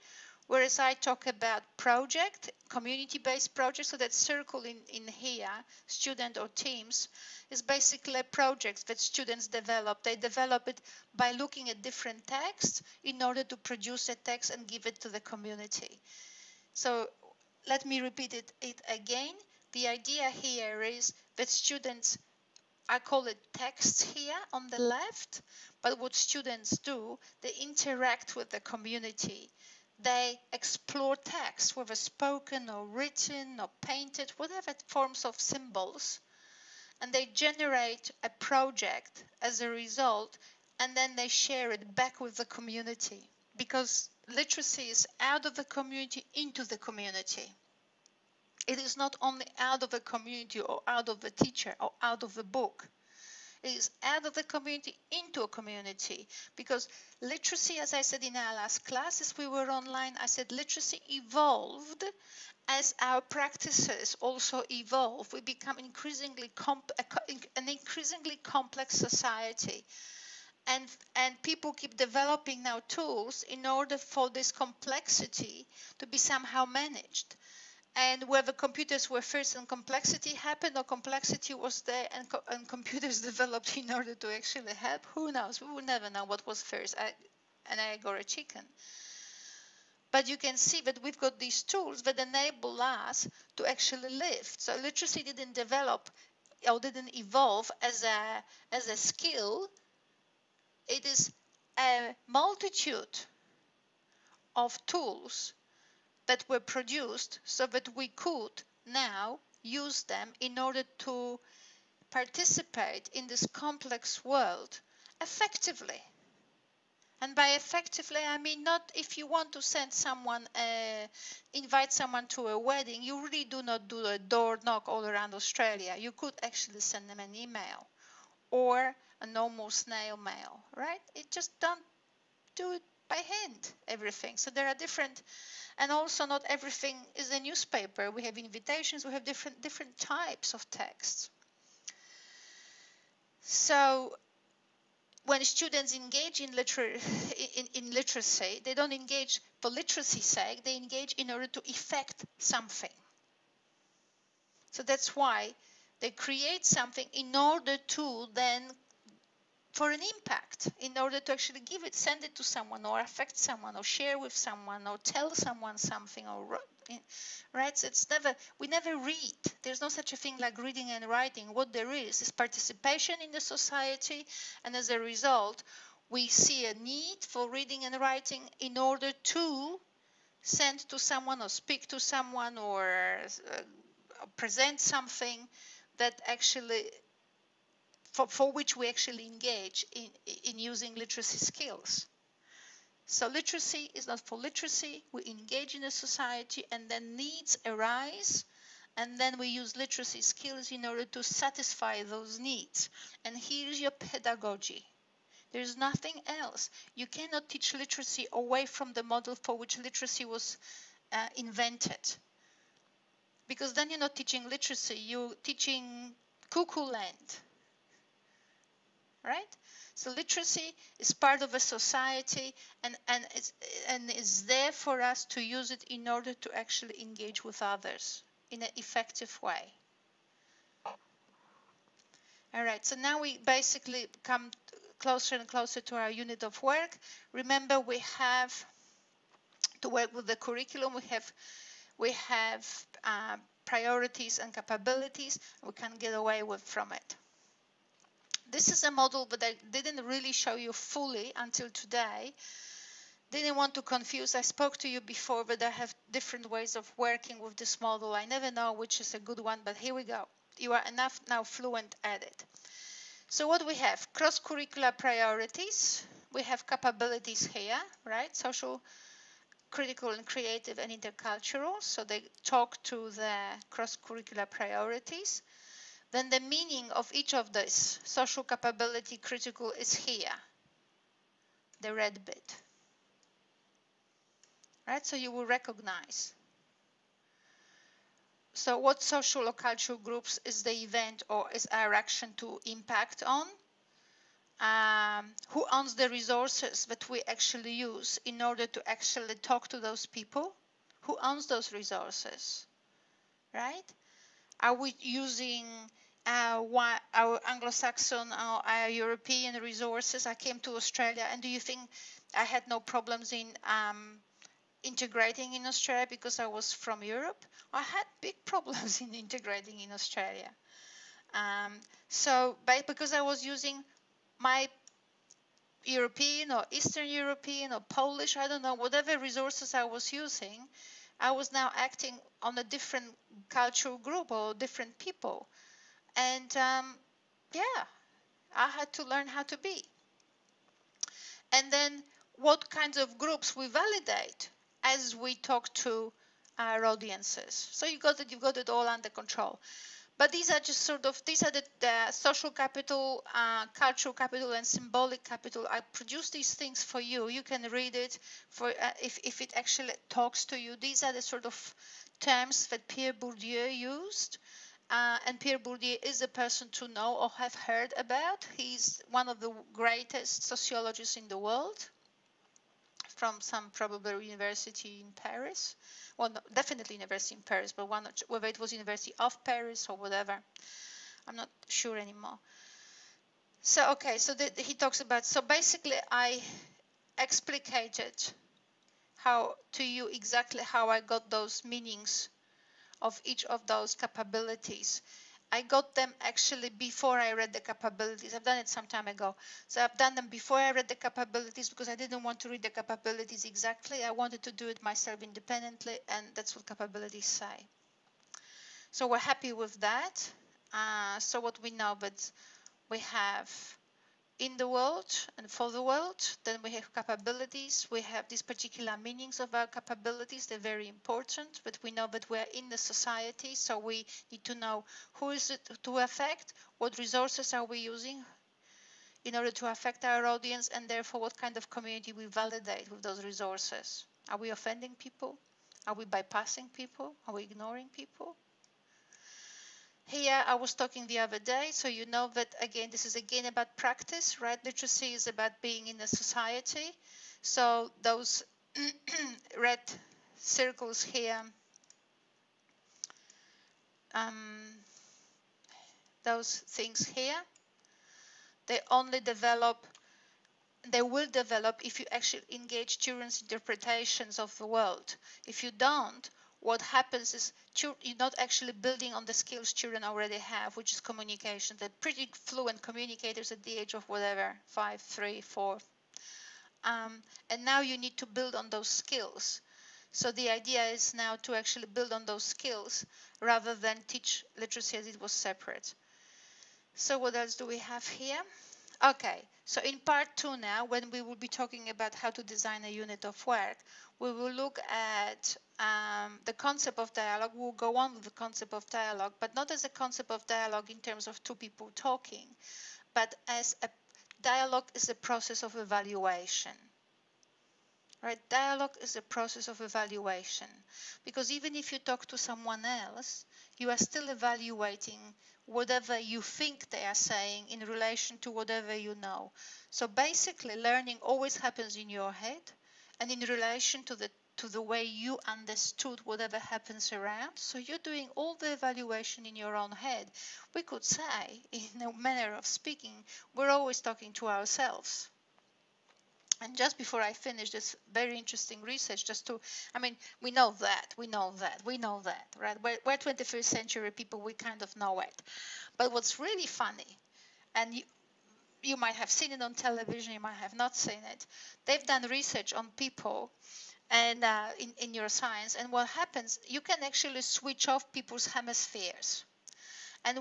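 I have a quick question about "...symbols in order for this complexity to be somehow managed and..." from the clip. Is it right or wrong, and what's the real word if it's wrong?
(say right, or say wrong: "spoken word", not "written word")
wrong: "tools", not "symbols".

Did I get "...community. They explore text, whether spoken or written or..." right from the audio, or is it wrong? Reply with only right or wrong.
right.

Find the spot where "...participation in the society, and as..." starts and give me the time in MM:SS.
02:52.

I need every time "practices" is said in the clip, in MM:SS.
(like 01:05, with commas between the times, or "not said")
01:03, 07:23.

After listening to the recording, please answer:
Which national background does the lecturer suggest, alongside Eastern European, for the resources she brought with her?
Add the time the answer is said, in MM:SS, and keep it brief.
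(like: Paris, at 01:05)
Polish, at 05:27.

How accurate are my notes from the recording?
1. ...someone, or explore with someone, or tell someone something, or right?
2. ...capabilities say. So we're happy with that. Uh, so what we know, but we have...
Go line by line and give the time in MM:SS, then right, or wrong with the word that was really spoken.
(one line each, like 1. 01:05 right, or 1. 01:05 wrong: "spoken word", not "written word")
1. 02:43 wrong: "share", not "explore"
2. 06:46 right.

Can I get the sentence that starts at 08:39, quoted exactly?
So basically, learning always happens in your head and in relation to the to the way you understood whatever happens around.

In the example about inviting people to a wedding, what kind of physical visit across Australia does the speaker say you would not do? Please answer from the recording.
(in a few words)
door knock.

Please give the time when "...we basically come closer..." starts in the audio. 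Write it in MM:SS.
03:53.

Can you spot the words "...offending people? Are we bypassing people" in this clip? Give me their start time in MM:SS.
07:14.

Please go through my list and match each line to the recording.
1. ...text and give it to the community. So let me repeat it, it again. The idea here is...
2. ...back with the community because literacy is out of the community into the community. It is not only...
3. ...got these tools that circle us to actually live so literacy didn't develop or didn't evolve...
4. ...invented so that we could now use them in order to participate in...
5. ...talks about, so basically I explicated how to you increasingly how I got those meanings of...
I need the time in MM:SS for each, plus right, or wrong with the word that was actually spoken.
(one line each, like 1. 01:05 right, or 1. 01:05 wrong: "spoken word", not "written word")
1. 00:14 right
2. 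00:41 right
3. 01:31 wrong: "enable", not "circle"
4. 01:46 wrong: "produced", not "invented"
5. 06:24 wrong: "exactly", not "increasingly".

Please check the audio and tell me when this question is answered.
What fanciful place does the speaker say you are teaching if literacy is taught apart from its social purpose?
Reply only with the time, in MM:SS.
03:36.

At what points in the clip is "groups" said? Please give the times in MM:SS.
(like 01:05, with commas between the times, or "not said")
04:50, 05:33, 05:43.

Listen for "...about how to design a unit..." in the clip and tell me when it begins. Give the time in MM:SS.
08:11.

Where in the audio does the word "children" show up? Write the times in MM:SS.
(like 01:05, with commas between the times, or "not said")
07:42, 07:49.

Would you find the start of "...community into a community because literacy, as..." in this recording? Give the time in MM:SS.
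00:54.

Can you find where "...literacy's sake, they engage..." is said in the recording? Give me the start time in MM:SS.
02:29.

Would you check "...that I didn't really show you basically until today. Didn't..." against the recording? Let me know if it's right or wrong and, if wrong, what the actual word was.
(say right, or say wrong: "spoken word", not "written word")
wrong: "fully", not "basically".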